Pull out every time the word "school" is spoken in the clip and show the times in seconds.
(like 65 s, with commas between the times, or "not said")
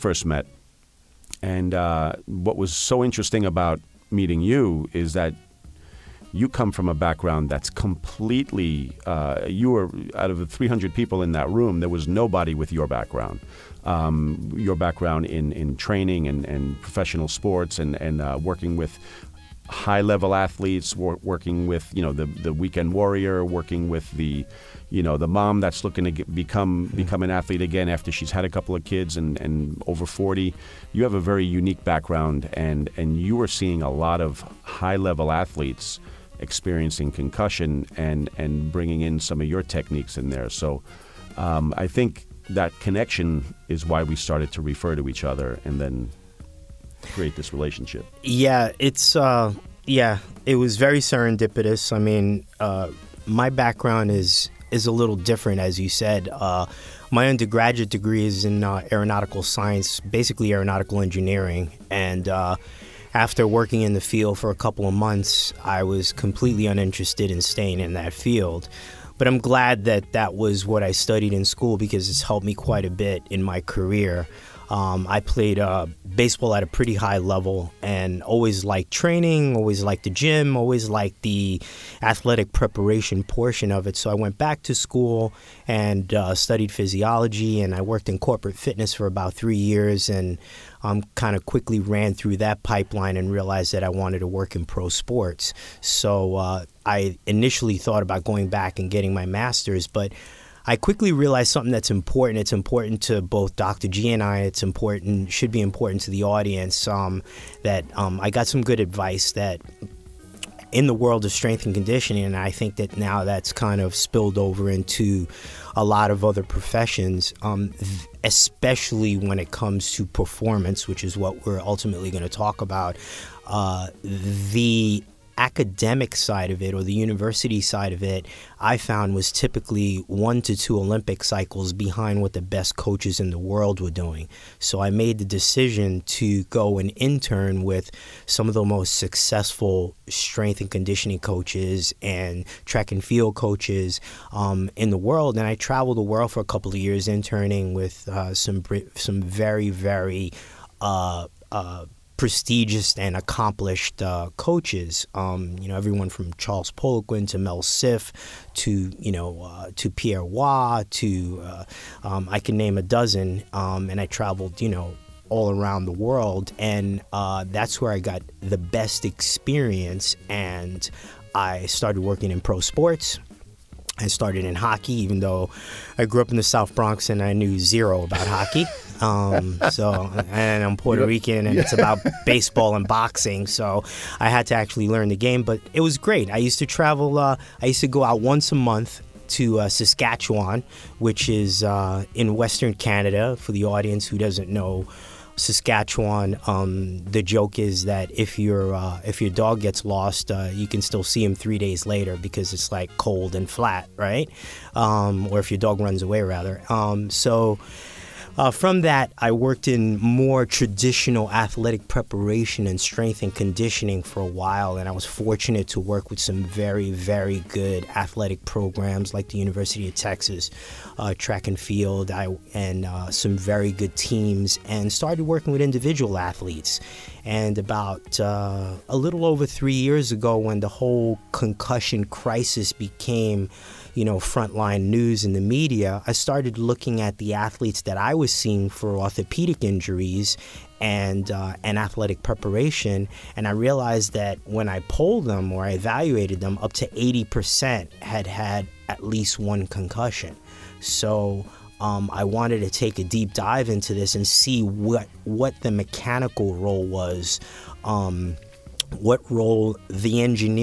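71 s, 84 s.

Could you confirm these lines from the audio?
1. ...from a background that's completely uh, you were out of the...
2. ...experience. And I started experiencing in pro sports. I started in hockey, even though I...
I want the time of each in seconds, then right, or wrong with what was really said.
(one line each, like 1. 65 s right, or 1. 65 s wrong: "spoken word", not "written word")
1. 6 s right
2. 169 s wrong: "working", not "experiencing".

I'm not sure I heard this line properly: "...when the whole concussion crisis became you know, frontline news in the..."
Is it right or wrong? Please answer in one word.
right.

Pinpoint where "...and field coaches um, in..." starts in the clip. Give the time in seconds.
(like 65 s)
142 s.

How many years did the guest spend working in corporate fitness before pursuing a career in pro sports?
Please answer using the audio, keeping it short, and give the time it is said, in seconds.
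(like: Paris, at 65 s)
3, at 89 s.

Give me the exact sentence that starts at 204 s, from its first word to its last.
Um, or if your dog runs away, rather.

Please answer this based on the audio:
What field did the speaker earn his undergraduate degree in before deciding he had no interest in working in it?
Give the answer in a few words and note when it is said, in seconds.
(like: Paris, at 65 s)
Aeronautical science, at 58 s.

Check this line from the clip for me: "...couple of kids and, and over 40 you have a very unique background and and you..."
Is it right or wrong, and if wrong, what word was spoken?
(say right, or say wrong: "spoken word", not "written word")
right.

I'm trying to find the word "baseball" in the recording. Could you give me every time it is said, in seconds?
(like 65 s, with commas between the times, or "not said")
76 s, 182 s.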